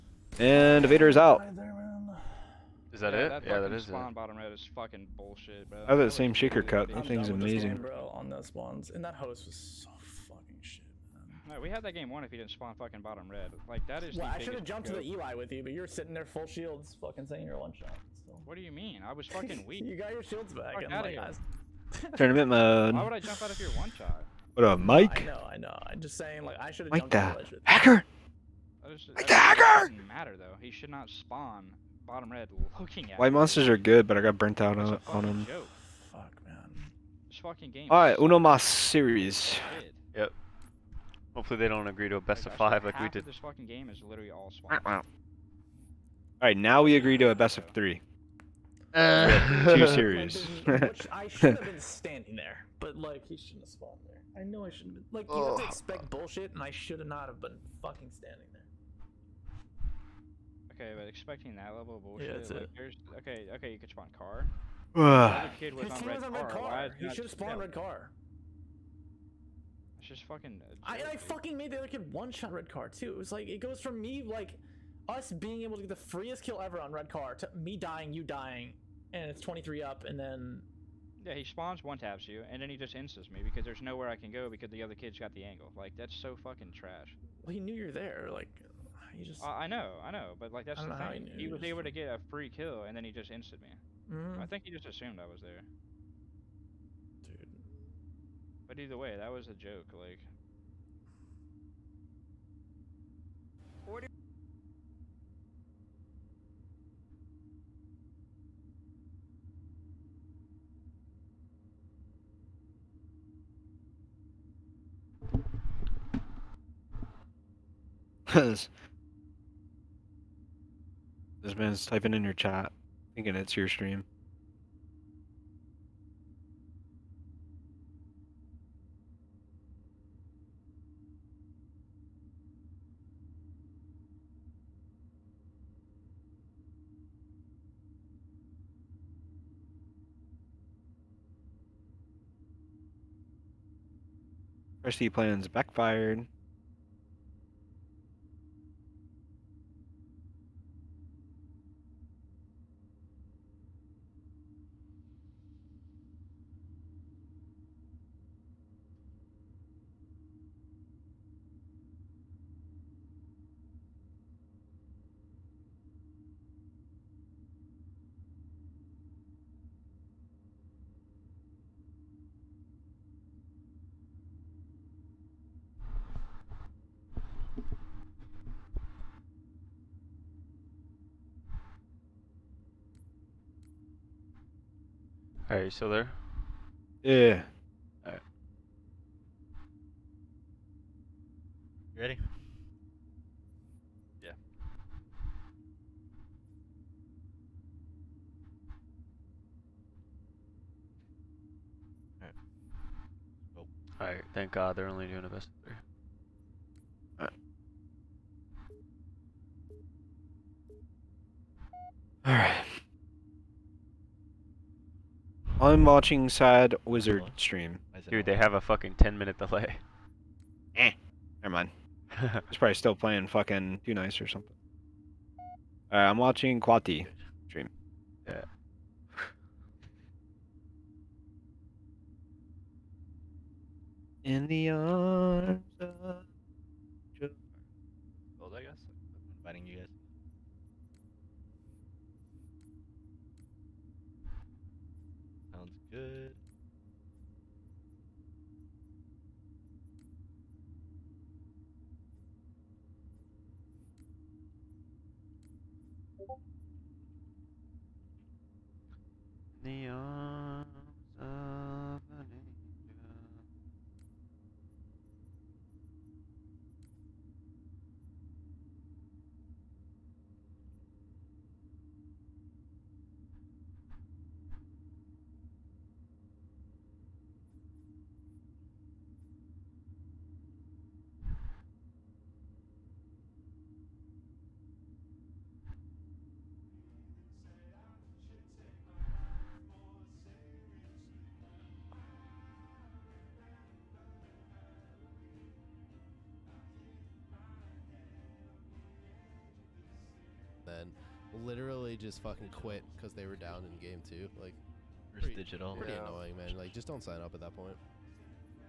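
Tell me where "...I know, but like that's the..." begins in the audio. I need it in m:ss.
1:30.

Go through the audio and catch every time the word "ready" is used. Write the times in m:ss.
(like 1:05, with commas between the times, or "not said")
3:11.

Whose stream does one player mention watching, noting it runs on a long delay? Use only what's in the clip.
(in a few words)
Sad Wizard.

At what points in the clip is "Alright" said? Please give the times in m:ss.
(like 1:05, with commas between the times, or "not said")
3:08, 3:22, 3:45.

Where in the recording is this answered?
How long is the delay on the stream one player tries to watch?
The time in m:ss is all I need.
3:38.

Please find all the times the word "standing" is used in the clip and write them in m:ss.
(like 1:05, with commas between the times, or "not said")
0:51, 0:58.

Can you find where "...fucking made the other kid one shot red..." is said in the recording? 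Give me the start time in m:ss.
1:11.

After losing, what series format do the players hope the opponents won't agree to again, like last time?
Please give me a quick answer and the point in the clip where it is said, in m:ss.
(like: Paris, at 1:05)
Best of five, at 0:42.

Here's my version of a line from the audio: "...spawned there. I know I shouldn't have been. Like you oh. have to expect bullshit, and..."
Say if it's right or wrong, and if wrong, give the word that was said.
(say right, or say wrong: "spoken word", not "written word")
right.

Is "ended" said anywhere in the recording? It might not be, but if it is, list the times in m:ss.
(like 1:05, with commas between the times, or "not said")
not said.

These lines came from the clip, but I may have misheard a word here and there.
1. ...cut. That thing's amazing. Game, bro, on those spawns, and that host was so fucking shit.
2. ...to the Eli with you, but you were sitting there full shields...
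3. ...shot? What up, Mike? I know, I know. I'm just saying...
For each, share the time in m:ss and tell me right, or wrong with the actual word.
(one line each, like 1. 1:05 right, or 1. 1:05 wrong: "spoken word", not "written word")
1. 0:06 right
2. 0:14 right
3. 0:23 right.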